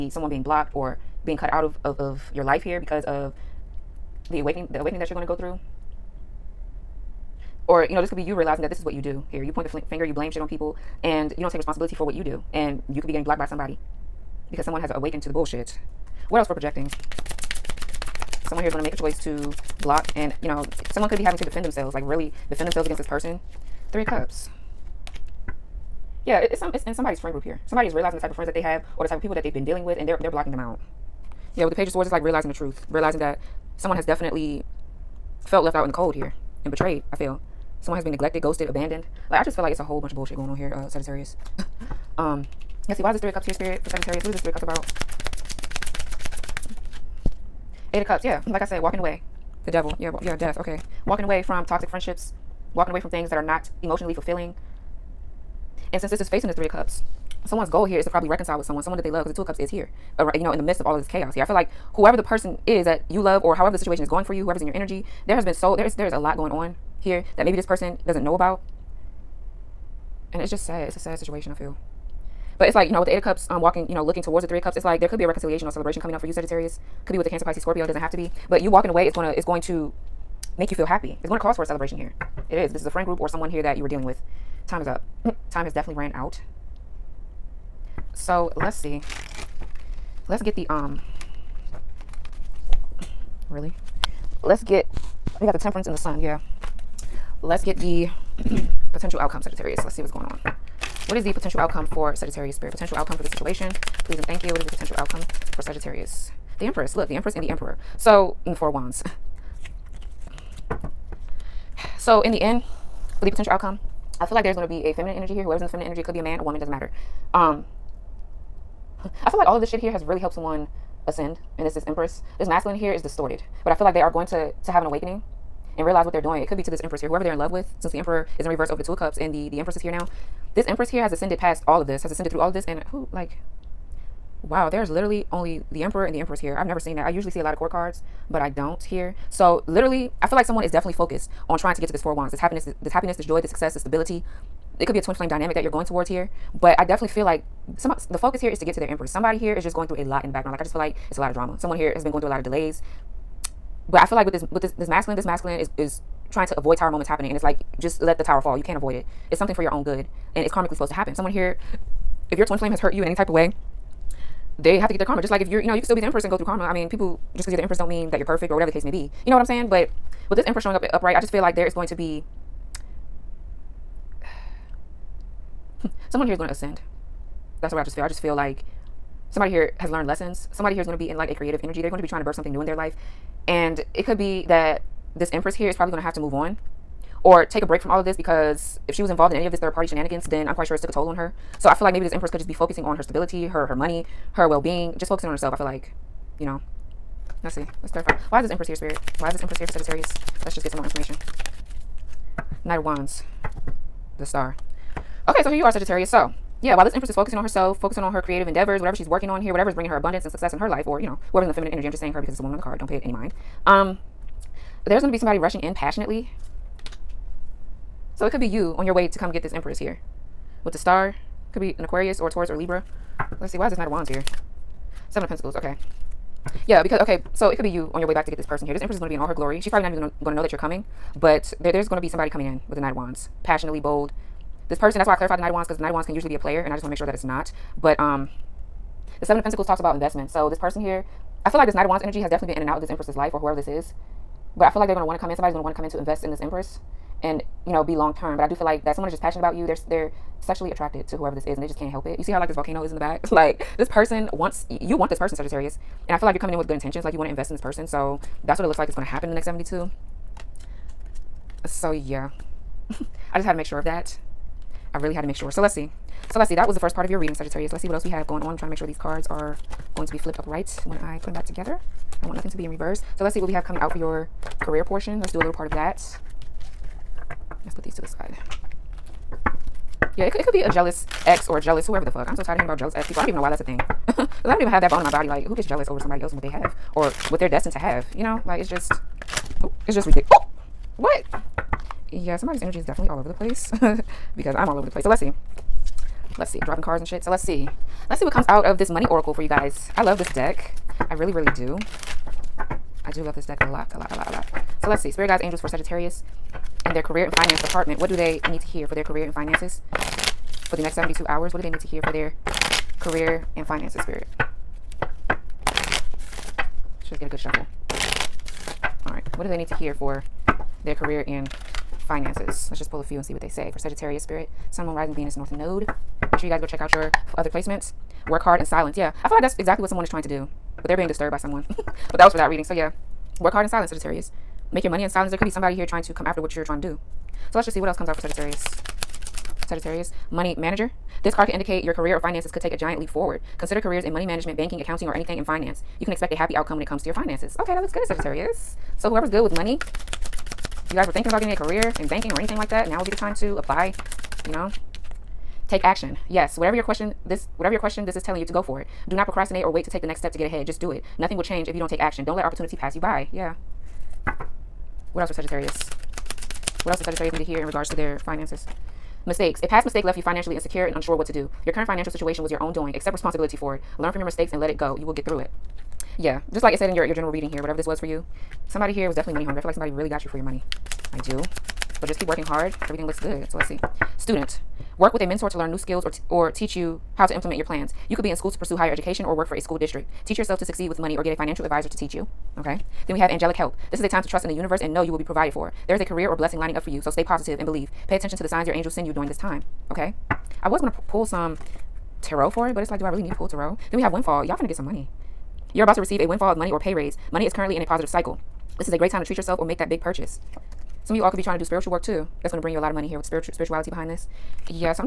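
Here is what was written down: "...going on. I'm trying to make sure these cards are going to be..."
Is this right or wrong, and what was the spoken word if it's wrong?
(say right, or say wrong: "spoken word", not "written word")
right.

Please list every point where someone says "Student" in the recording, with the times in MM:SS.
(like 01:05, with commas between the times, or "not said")
06:24.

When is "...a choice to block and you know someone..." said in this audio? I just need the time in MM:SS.
00:18.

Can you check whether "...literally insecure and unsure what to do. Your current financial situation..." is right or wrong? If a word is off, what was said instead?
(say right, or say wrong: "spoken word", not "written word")
wrong: "financially", not "literally".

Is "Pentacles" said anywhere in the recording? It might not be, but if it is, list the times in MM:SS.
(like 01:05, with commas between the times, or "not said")
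03:45, 03:59.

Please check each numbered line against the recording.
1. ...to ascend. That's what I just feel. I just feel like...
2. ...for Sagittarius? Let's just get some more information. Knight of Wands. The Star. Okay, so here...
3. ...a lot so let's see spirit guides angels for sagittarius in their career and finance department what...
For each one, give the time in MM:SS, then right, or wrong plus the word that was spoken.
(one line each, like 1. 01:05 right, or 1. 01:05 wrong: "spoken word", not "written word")
1. 02:56 right
2. 03:19 right
3. 05:04 right.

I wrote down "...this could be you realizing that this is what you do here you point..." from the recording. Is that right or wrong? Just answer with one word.
right.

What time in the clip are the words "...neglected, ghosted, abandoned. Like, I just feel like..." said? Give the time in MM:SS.
00:38.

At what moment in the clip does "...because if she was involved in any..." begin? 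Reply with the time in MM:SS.
03:08.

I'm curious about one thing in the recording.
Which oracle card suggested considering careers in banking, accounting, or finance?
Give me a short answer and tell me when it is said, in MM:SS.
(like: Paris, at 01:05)
money manager, at 05:40.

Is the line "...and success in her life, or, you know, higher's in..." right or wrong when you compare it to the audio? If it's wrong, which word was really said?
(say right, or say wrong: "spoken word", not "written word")
wrong: "whoever", not "higher".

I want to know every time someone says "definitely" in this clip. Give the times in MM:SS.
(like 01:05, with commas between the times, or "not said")
00:34, 01:25, 02:20, 02:26, 04:02, 04:52, 06:19.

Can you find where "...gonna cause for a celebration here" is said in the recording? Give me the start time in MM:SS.
01:21.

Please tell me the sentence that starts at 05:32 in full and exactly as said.
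So yeah, work hard in silence, Sagittarius.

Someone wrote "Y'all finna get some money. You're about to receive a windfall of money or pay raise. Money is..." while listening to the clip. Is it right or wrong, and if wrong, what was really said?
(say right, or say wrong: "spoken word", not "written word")
right.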